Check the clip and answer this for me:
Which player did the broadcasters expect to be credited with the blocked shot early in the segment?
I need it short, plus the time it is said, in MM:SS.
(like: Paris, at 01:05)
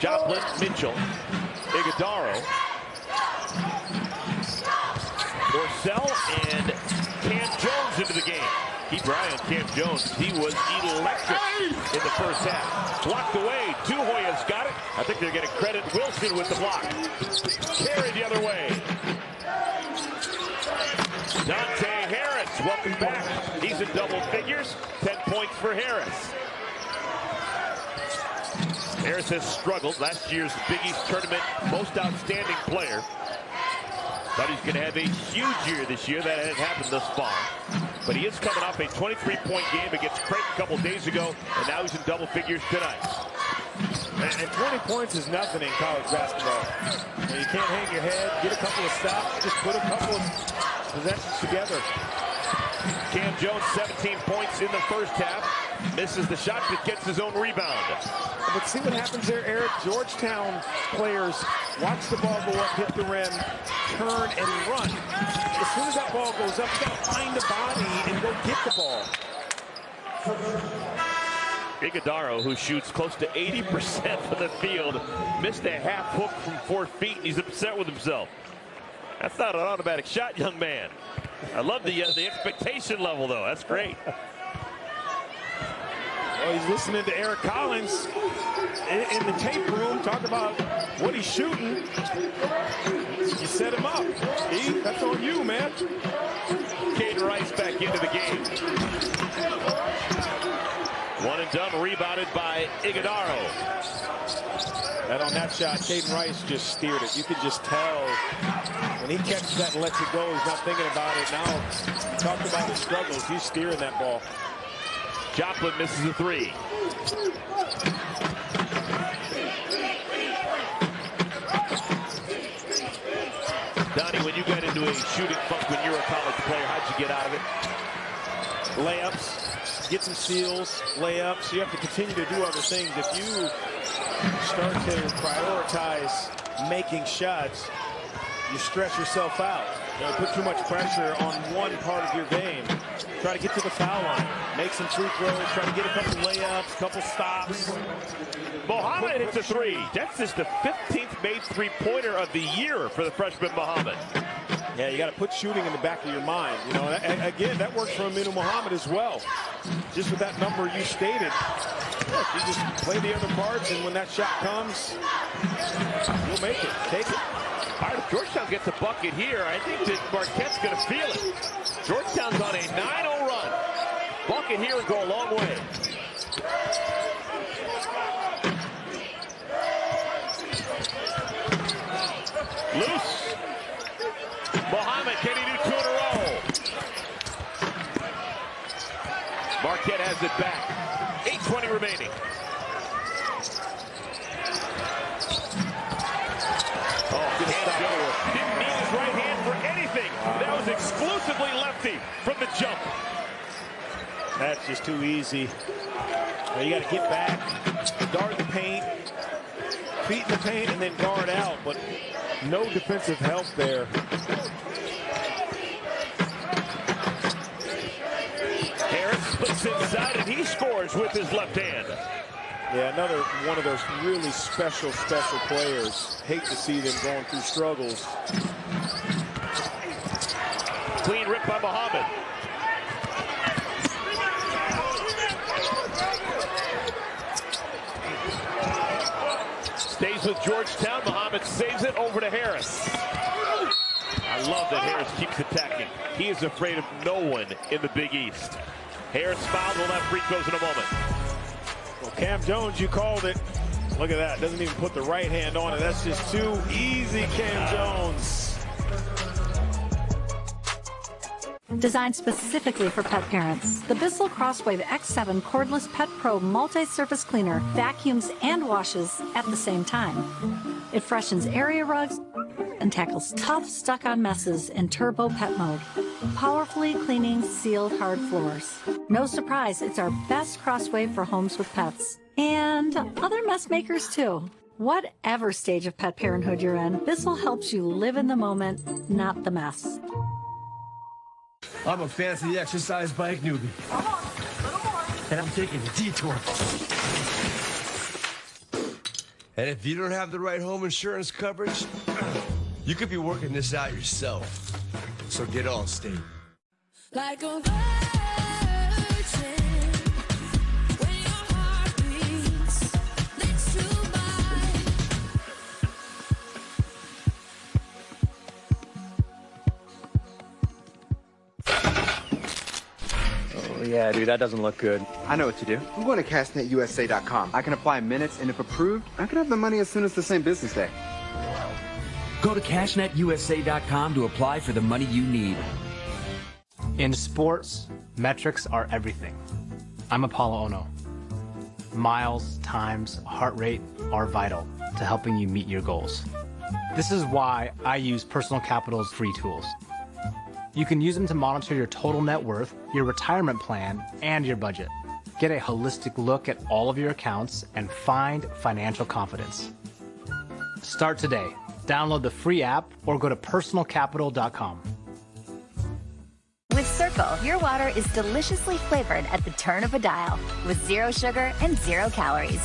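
Wilson, at 00:15.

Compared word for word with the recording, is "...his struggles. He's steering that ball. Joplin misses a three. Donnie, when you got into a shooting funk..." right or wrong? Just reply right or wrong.
right.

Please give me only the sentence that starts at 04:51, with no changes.
I'm a fancy exercise bike newbie.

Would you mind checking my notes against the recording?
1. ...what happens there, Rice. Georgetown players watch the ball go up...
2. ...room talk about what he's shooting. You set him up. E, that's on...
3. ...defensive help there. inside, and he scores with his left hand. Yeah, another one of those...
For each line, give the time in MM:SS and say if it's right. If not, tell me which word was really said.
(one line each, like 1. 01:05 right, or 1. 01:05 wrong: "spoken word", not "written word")
1. 00:58 wrong: "Eric", not "Rice"
2. 01:29 right
3. 03:32 right.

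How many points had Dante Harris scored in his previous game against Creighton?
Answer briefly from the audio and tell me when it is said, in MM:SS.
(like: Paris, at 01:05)
23, at 00:38.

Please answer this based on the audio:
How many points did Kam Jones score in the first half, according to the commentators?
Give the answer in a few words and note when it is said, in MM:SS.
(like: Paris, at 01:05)
17, at 00:53.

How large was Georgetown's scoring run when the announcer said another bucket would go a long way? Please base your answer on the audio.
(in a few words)
9-0.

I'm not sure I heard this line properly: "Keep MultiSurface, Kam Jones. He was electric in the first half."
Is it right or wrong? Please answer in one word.
wrong.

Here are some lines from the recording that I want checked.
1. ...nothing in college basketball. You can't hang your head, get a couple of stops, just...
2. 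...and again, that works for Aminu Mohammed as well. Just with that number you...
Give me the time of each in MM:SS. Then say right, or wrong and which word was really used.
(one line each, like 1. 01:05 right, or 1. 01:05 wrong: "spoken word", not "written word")
1. 00:45 right
2. 02:36 right.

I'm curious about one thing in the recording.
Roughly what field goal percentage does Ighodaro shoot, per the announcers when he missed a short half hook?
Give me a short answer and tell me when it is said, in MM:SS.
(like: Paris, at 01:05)
80%, at 01:13.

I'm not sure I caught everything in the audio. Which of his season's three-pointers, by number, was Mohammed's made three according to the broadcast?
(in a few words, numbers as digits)
15th.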